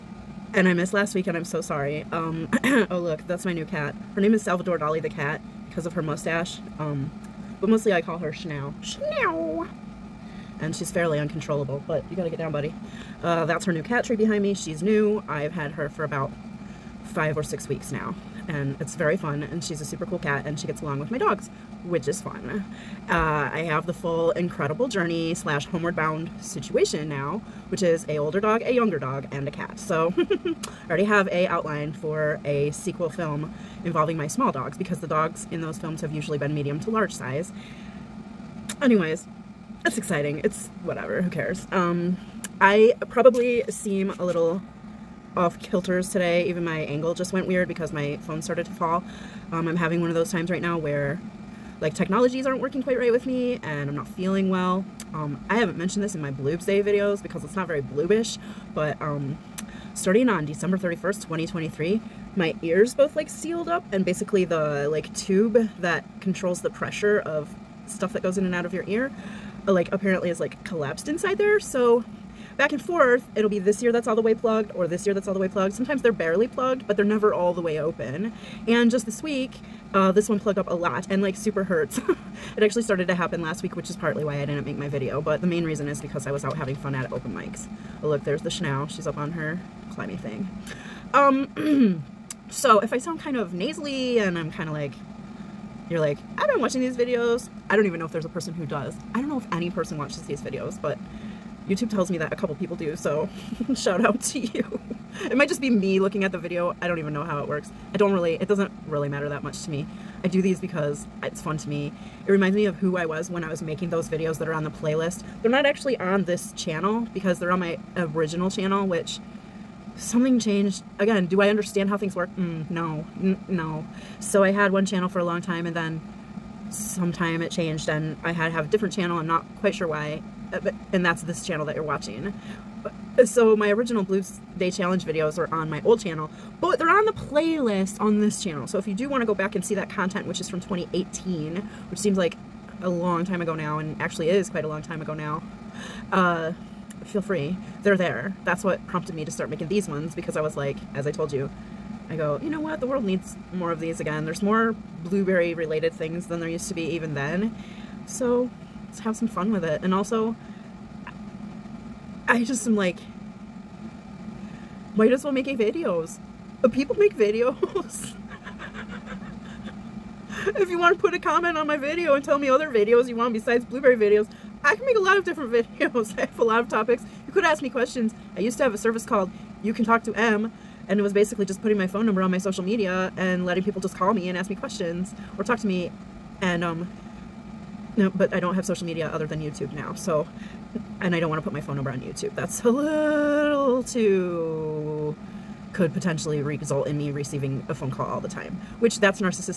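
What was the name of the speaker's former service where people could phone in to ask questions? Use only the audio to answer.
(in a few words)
You Can Talk to Em.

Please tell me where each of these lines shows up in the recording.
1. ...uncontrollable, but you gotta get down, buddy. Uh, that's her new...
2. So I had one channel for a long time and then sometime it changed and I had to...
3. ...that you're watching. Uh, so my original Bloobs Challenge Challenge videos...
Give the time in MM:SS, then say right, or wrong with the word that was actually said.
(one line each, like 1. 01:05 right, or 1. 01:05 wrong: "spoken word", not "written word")
1. 00:11 right
2. 02:04 right
3. 02:11 wrong: "Day", not "Challenge".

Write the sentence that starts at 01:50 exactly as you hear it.
I do these because it's fun to me.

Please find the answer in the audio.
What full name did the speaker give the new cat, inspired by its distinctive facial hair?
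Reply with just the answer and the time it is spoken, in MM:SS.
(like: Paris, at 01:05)
Salvador Dali, at 00:04.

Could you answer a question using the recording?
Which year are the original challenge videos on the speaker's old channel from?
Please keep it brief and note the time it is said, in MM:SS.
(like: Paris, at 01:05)
2018, at 02:20.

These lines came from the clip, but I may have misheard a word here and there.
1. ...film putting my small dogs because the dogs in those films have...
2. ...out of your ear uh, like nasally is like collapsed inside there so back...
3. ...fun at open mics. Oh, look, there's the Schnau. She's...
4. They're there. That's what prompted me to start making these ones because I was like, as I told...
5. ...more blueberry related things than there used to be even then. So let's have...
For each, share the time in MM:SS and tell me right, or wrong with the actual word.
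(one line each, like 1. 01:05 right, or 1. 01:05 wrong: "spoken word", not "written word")
1. 00:33 wrong: "involving", not "putting"
2. 01:08 wrong: "apparently", not "nasally"
3. 01:26 right
4. 02:27 right
5. 02:34 right.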